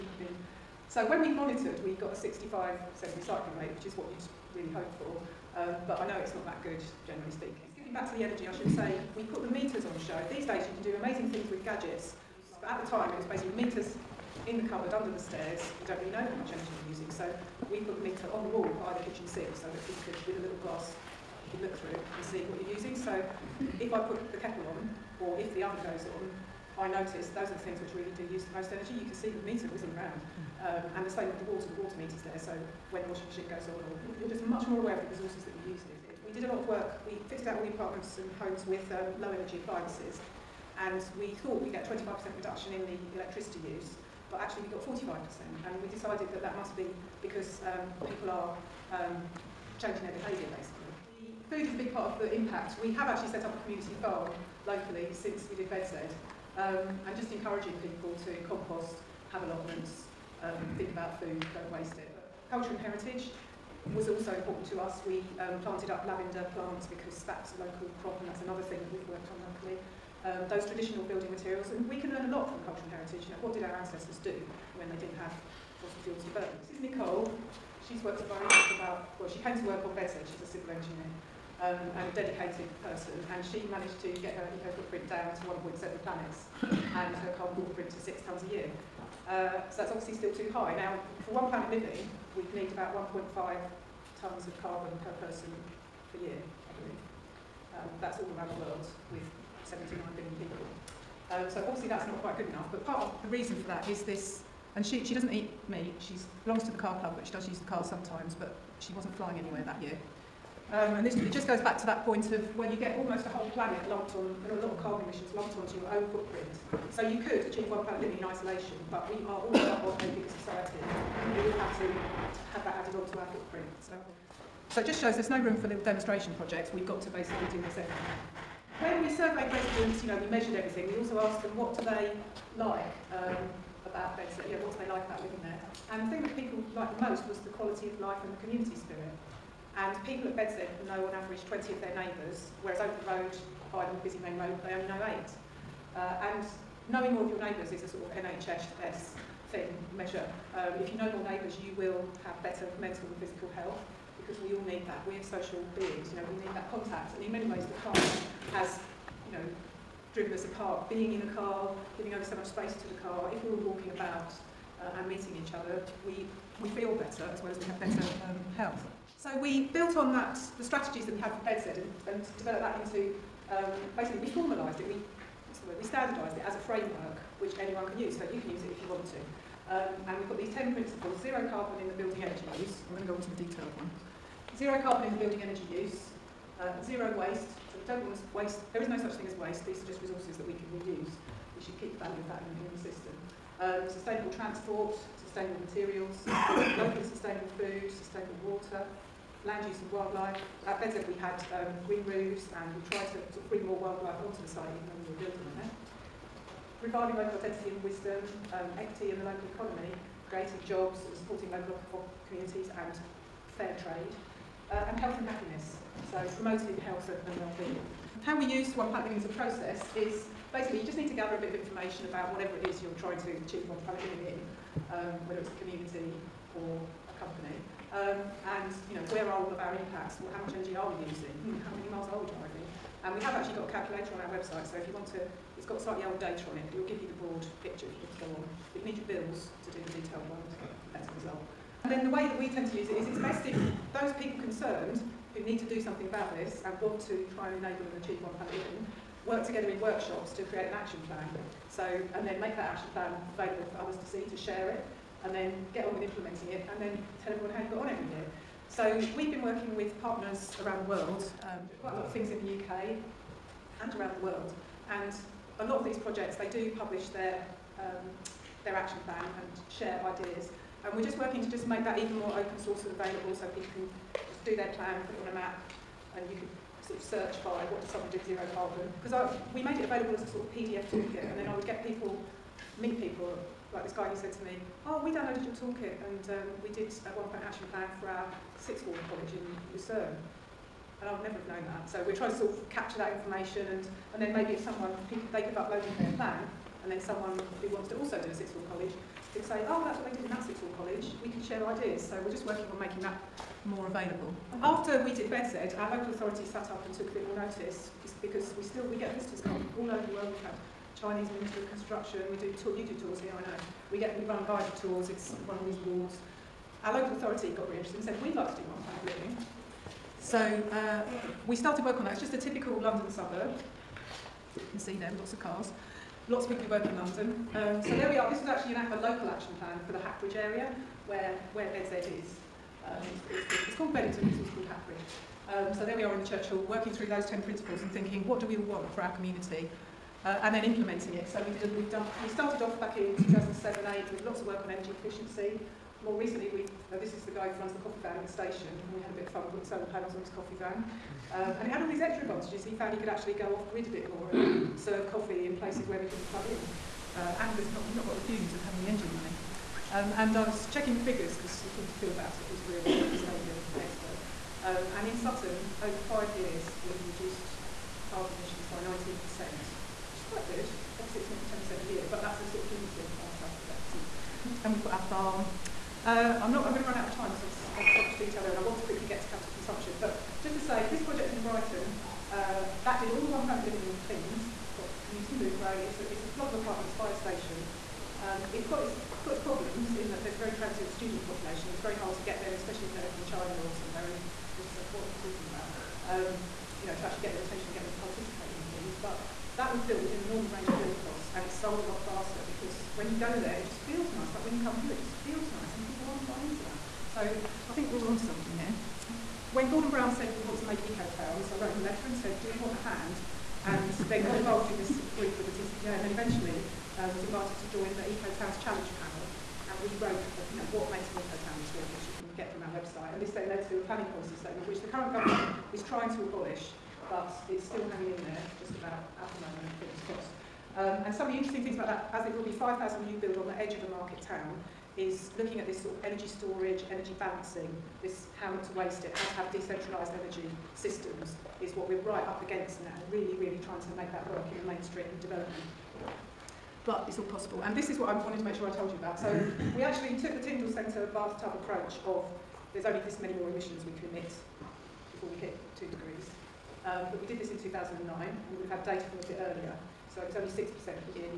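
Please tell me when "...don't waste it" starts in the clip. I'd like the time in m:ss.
1:01.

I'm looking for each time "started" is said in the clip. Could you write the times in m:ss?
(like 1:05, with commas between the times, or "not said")
5:21, 5:42.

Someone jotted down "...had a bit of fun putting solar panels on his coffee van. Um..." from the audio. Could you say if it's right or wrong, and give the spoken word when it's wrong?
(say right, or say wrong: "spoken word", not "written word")
right.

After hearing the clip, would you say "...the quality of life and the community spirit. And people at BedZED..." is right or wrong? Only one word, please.
right.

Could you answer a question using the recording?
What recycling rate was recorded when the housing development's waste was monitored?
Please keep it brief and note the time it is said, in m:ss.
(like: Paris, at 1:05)
65%, at 0:02.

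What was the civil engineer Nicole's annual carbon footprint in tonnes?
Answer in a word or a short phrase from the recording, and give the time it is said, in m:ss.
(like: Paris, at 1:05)
6 tonnes, at 1:27.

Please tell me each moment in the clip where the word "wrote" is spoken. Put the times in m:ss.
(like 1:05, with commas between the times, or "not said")
6:51, 6:59.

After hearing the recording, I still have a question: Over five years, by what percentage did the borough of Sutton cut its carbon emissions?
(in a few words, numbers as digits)
19%.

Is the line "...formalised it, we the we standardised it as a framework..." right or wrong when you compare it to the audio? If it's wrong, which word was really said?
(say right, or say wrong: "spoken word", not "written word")
right.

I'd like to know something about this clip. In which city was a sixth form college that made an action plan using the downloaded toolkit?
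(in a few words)
Lucerne.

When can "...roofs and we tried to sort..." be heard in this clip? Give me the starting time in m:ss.
3:22.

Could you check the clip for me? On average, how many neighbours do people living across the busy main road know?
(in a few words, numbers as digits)
8.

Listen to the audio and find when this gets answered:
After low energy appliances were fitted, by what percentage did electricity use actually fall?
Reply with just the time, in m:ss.
0:44.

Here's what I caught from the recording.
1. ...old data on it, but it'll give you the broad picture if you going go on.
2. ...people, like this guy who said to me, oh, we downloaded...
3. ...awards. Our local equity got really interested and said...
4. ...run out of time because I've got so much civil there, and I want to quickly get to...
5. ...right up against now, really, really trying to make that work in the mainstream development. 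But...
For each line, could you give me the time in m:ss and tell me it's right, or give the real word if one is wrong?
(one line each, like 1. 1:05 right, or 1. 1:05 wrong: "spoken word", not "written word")
1. 3:56 right
2. 4:42 right
3. 5:15 wrong: "authority", not "equity"
4. 6:16 wrong: "detail", not "civil"
5. 7:22 right.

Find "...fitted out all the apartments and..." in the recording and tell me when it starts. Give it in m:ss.
0:37.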